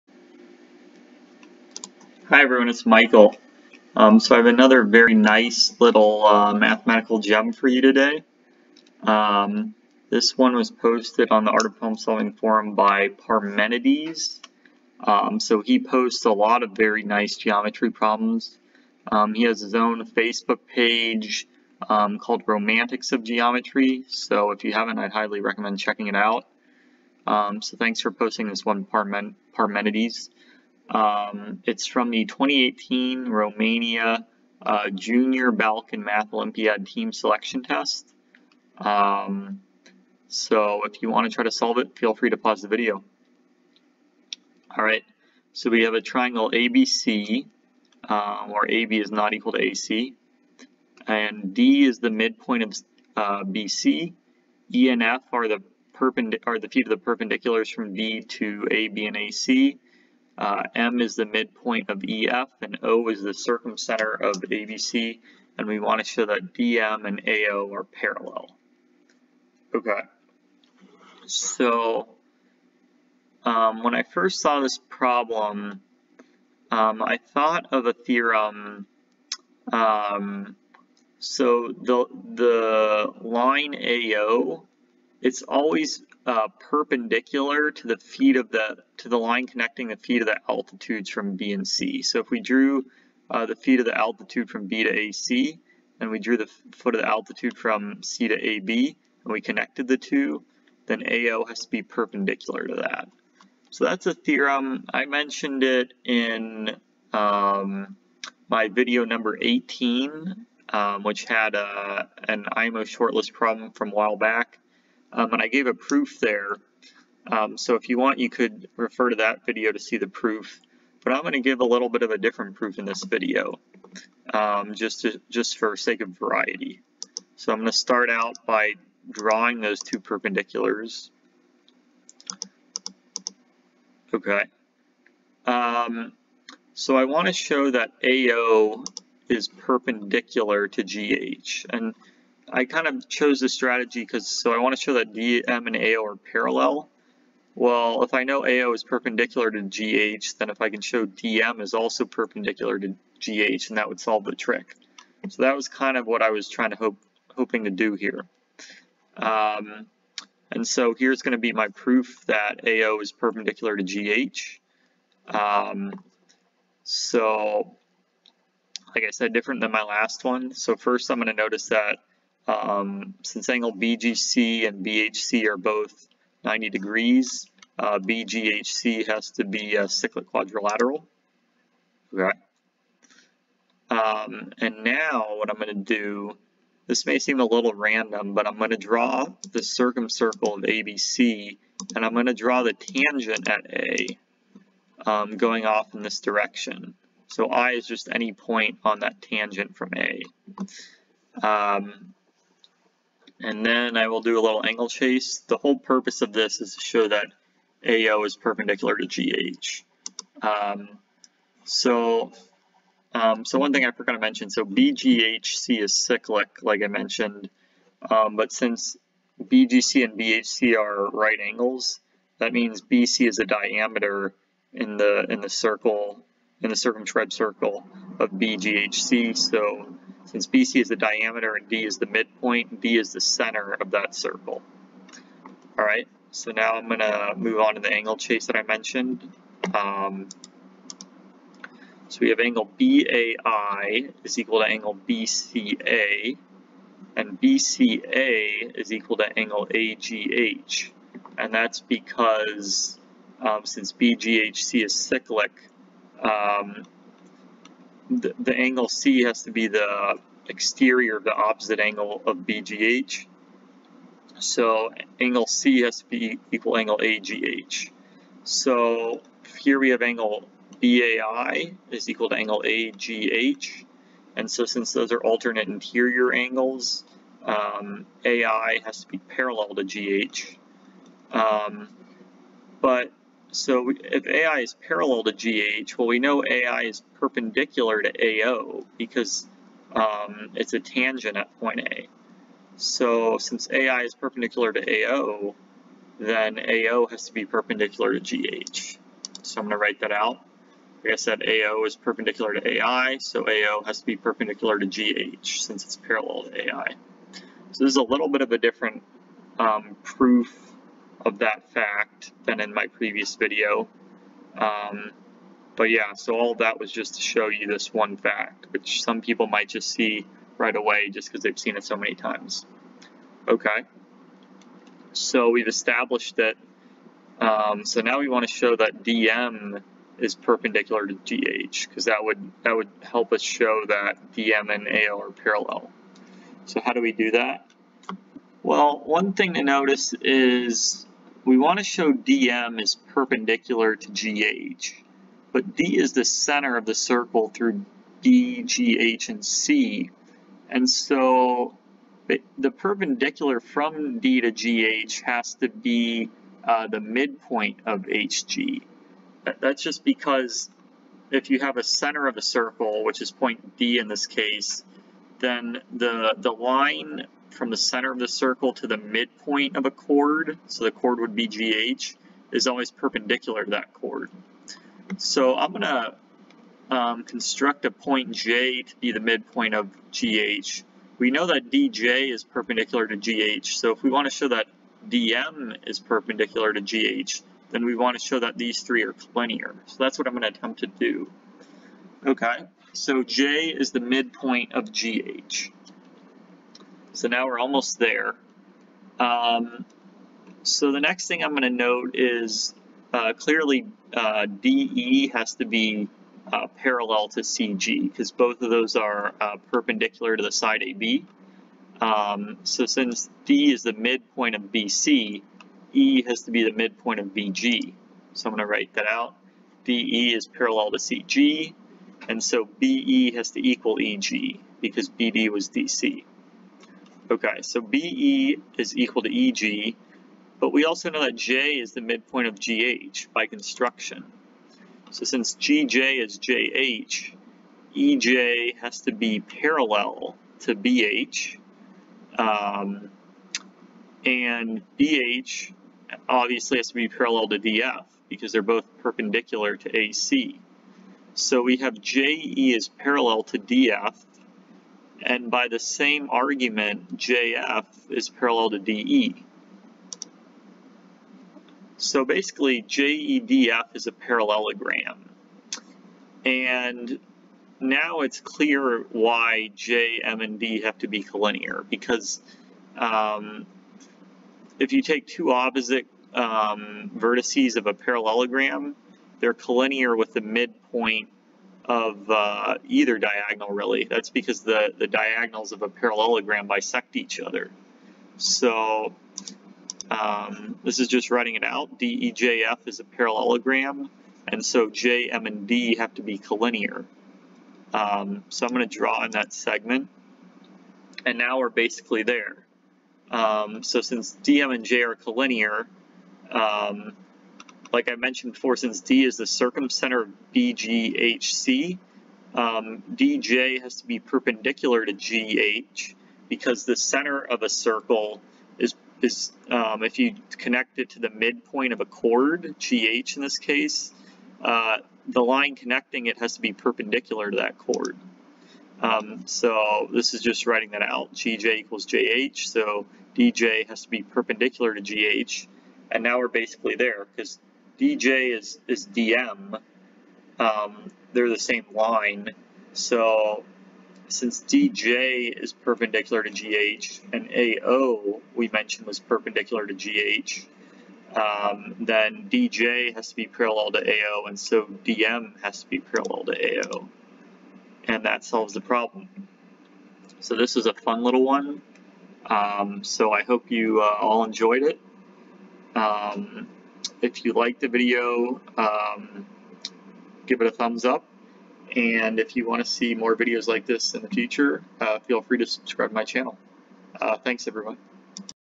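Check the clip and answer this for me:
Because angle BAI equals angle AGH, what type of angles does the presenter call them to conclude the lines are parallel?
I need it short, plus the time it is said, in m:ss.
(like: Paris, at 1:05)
alternate interior angles, at 4:35.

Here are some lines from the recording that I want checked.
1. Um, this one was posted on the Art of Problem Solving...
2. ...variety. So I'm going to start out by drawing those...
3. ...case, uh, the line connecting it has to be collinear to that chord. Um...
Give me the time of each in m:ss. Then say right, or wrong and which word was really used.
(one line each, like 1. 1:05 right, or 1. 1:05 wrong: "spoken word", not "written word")
1. 0:09 right
2. 2:06 right
3. 8:43 wrong: "perpendicular", not "collinear".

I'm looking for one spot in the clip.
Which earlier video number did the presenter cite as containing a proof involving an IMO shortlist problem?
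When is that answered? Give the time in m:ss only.
1:49.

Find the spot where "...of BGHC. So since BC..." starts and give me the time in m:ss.
3:48.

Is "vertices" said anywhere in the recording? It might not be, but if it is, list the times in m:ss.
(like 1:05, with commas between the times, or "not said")
7:57.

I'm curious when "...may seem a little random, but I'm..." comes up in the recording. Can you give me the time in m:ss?
3:07.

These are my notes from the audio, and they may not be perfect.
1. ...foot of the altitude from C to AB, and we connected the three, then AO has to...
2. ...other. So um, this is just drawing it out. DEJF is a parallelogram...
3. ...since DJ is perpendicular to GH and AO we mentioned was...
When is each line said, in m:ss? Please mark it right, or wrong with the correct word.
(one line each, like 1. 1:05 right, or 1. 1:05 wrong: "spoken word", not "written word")
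1. 1:36 wrong: "two", not "three"
2. 8:07 wrong: "writing", not "drawing"
3. 9:04 right.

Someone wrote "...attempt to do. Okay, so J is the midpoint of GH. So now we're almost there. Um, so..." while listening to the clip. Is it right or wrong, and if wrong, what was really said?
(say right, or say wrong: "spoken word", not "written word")
right.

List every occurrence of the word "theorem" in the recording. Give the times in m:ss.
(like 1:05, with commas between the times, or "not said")
1:17, 1:44.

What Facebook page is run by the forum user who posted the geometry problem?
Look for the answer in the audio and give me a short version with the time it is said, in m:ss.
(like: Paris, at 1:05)
Romantics of Geometry, at 0:22.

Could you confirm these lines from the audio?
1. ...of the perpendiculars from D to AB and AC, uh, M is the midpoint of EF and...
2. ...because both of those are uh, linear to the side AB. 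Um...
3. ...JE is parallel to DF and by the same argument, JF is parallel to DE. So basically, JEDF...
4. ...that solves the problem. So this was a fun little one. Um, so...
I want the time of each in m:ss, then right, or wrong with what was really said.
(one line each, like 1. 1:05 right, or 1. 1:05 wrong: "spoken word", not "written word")
1. 0:56 right
2. 6:48 wrong: "perpendicular", not "linear"
3. 7:32 right
4. 9:18 right.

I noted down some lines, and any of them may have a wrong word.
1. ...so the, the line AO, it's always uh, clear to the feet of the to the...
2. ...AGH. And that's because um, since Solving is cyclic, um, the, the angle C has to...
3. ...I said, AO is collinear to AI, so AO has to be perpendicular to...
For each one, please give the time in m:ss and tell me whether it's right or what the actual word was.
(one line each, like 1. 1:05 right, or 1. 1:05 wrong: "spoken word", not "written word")
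1. 1:21 wrong: "perpendicular", not "clear"
2. 4:09 wrong: "BGHC", not "Solving"
3. 5:01 wrong: "perpendicular", not "collinear".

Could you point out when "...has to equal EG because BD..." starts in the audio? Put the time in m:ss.
7:03.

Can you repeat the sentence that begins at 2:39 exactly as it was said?
Um, and so here's going to be my proof that AO is perpendicular to GH.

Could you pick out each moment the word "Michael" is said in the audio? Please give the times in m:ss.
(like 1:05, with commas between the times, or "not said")
0:02.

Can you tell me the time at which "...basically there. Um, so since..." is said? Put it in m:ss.
8:21.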